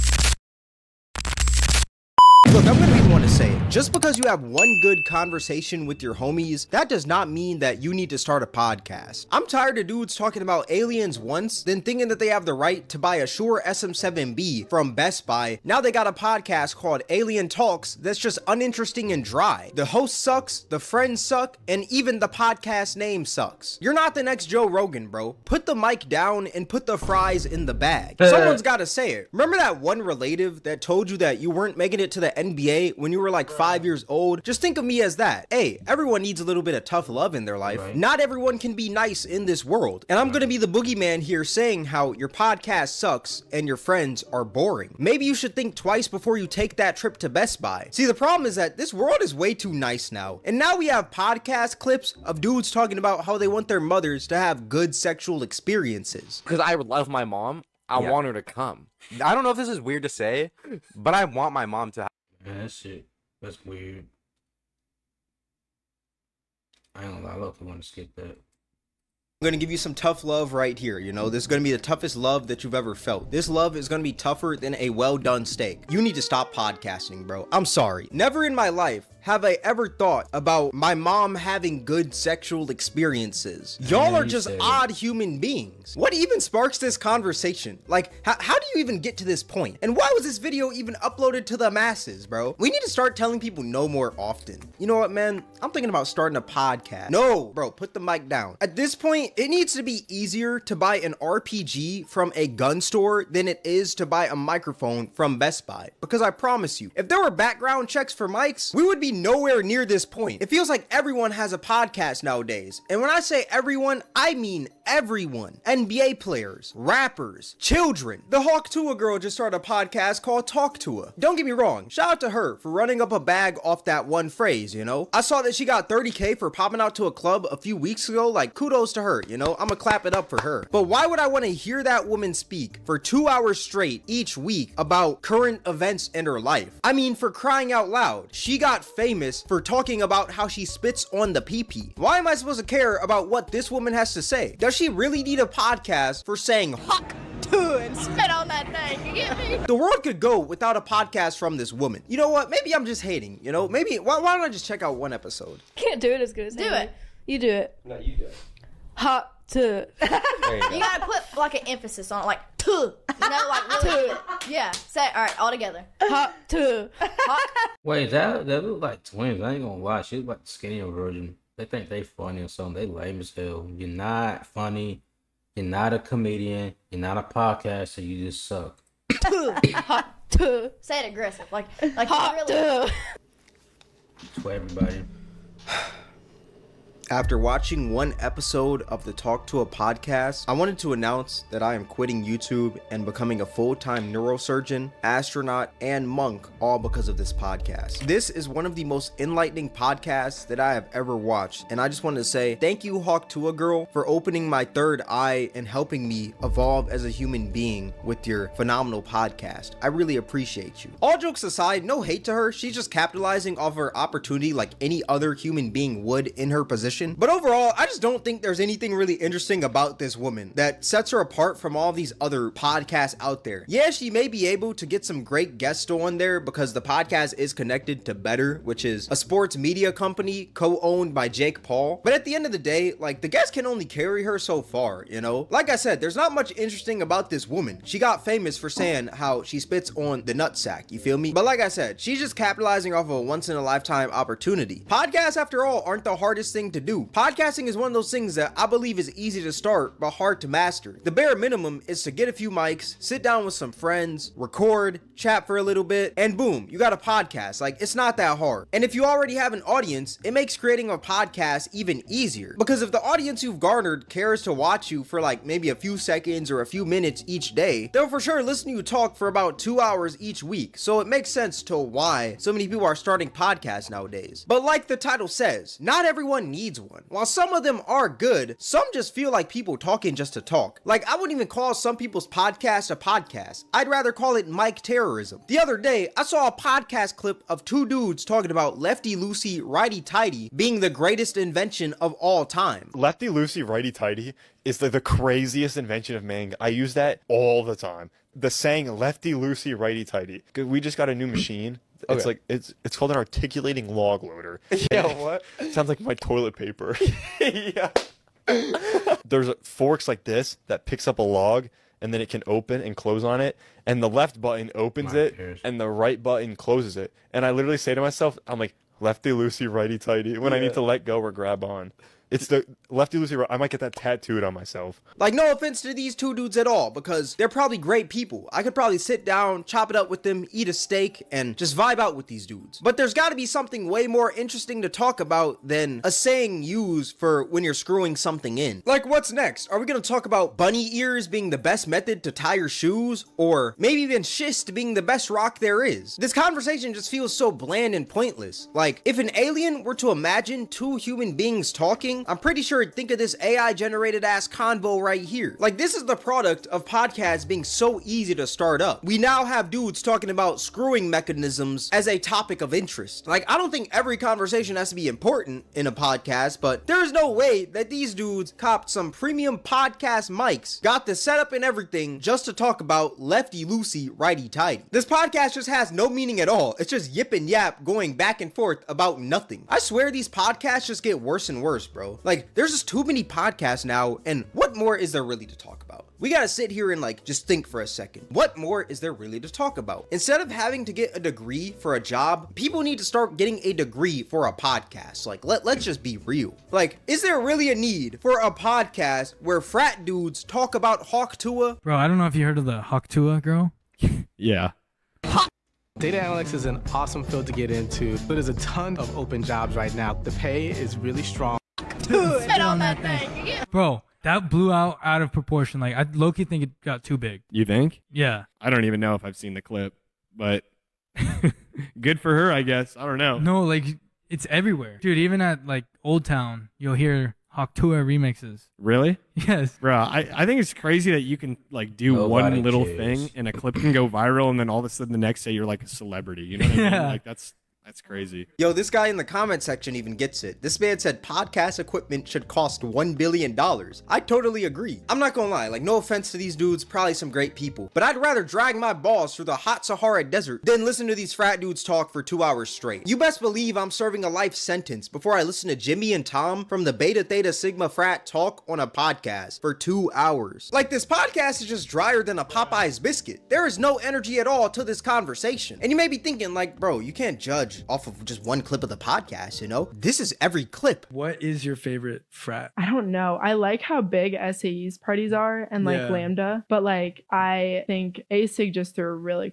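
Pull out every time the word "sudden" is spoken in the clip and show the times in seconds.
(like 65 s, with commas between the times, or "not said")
434 s.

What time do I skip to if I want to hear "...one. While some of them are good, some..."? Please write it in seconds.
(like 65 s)
276 s.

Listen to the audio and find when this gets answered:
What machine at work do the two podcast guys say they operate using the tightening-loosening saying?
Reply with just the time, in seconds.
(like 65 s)
303 s.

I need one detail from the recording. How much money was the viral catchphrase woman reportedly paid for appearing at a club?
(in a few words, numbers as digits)
30k.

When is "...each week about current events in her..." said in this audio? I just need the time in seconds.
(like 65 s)
134 s.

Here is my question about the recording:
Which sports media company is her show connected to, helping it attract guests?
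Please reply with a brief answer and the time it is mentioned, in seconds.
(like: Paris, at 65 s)
Betr, at 228 s.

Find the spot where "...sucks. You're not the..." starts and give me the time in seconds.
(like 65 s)
23 s.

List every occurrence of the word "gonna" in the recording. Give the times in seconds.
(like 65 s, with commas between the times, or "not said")
2 s, 67 s, 129 s, 169 s, 339 s, 445 s.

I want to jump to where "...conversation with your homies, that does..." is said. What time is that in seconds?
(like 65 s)
5 s.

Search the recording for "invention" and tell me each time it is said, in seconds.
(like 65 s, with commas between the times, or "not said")
291 s, 295 s.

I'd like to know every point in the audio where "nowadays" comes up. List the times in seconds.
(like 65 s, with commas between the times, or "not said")
112 s, 273 s.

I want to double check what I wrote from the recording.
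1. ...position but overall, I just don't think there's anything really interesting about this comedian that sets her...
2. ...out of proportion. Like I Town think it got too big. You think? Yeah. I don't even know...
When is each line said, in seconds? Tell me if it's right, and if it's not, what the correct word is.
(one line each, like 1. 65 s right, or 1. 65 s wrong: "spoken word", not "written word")
1. 216 s wrong: "woman", not "comedian"
2. 415 s wrong: "Loki", not "Town".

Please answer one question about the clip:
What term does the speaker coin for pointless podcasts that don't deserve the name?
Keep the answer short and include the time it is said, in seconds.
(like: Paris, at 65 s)
mic terrorism, at 284 s.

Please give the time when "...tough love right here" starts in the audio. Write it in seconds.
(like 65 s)
69 s.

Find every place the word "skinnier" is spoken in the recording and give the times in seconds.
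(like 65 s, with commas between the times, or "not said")
170 s.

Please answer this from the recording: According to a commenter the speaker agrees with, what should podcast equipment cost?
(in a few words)
$1 billion.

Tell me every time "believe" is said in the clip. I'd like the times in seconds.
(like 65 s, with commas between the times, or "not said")
248 s, 453 s.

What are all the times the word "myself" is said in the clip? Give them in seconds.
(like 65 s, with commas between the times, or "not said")
318 s, 324 s.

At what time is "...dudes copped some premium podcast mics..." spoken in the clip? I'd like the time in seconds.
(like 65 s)
368 s.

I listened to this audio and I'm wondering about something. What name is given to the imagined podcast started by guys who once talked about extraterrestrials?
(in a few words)
Alien Talks.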